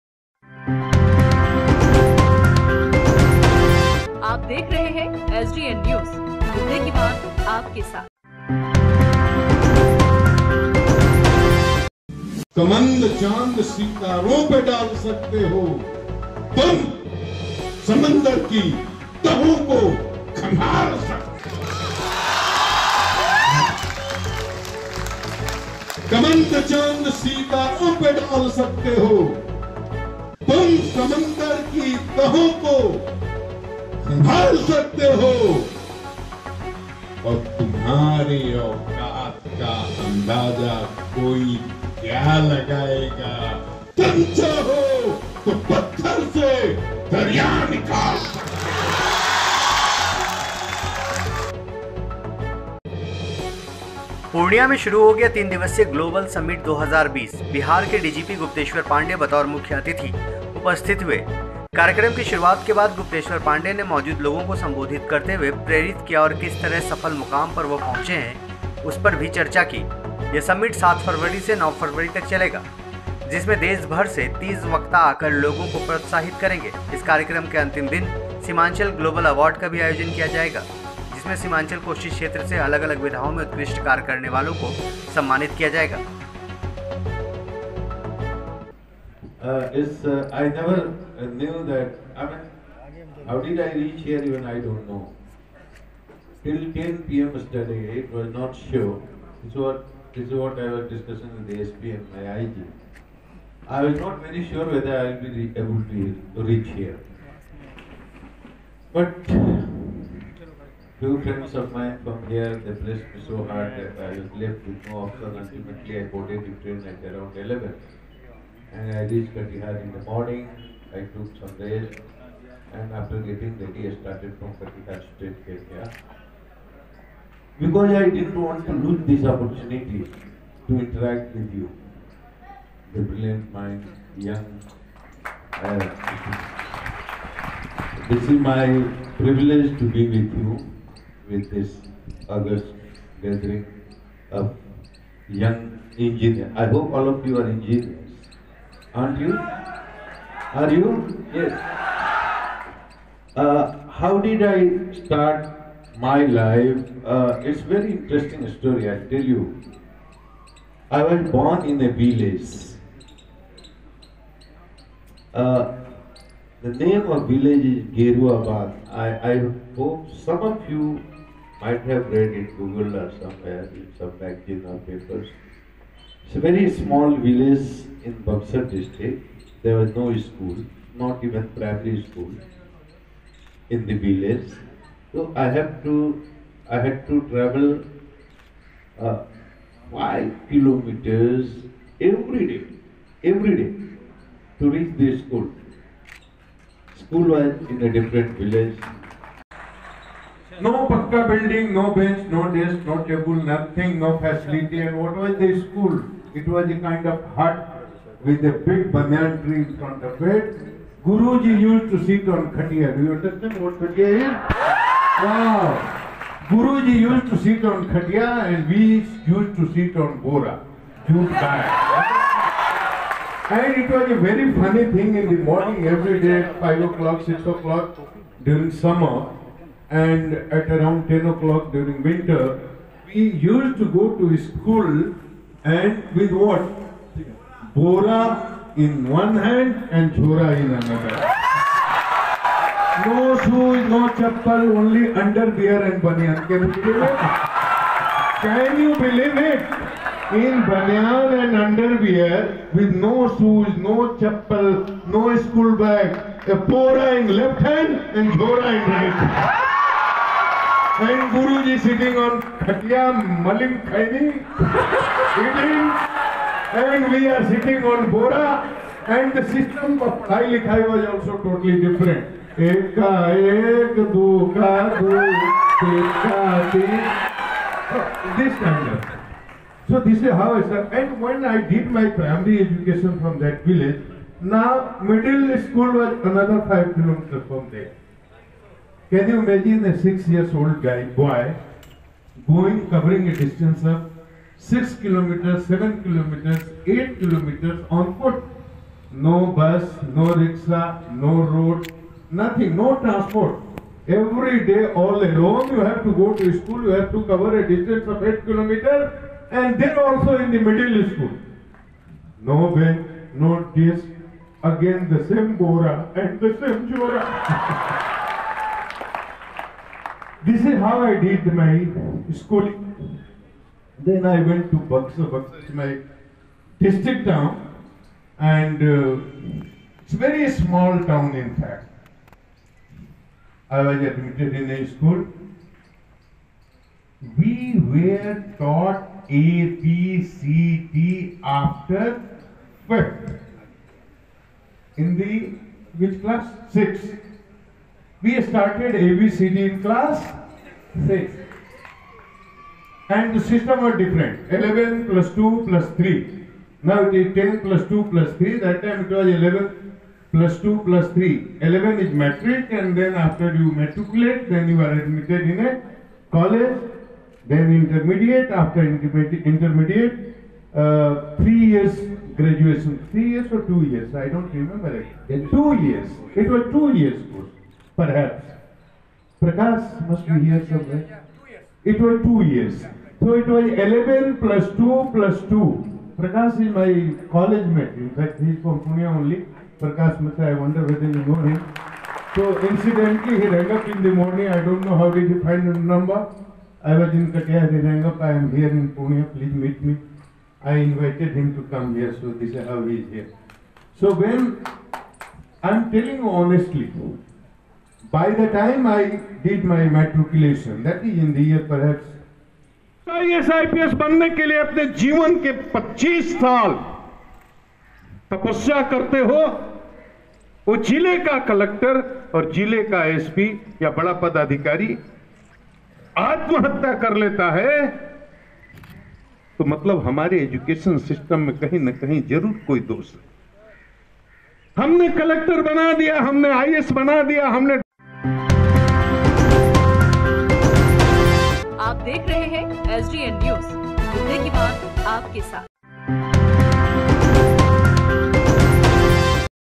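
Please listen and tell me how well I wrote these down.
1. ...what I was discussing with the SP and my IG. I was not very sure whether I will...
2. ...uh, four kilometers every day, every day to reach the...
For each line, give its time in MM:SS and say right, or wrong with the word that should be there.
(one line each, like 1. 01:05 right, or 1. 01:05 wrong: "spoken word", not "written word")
1. 01:40 right
2. 03:09 wrong: "five", not "four".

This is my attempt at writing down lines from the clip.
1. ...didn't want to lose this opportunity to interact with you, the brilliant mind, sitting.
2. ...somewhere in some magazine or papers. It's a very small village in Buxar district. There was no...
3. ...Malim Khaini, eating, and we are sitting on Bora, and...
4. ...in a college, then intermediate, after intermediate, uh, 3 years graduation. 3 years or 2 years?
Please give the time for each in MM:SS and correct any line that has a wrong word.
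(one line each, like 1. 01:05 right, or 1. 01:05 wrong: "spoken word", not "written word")
1. 02:08 wrong: "young", not "sitting"
2. 02:53 right
3. 04:23 right
4. 06:05 right.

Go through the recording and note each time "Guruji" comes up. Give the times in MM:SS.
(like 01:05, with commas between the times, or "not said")
03:31, 03:36, 04:21.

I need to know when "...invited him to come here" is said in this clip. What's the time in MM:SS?
06:40.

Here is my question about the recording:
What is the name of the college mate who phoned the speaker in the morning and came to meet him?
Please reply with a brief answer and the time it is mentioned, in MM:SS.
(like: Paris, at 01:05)
Prakash Mitra, at 06:29.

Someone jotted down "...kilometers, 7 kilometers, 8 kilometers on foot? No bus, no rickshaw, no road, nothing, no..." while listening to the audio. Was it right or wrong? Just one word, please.
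right.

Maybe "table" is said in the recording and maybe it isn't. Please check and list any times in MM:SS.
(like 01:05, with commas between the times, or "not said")
03:23.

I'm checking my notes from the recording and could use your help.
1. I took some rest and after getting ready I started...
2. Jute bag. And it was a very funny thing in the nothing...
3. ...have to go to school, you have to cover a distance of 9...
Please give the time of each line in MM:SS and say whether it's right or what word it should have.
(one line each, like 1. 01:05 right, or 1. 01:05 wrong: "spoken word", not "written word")
1. 02:00 right
2. 03:41 wrong: "morning", not "nothing"
3. 05:05 wrong: "8", not "9".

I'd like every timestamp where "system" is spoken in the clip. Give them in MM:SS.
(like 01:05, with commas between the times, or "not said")
04:29, 05:53.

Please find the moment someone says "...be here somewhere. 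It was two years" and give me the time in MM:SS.
06:20.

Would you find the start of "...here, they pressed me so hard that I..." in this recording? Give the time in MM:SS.
01:52.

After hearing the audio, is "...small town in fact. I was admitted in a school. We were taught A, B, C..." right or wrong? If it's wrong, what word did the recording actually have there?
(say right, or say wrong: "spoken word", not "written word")
right.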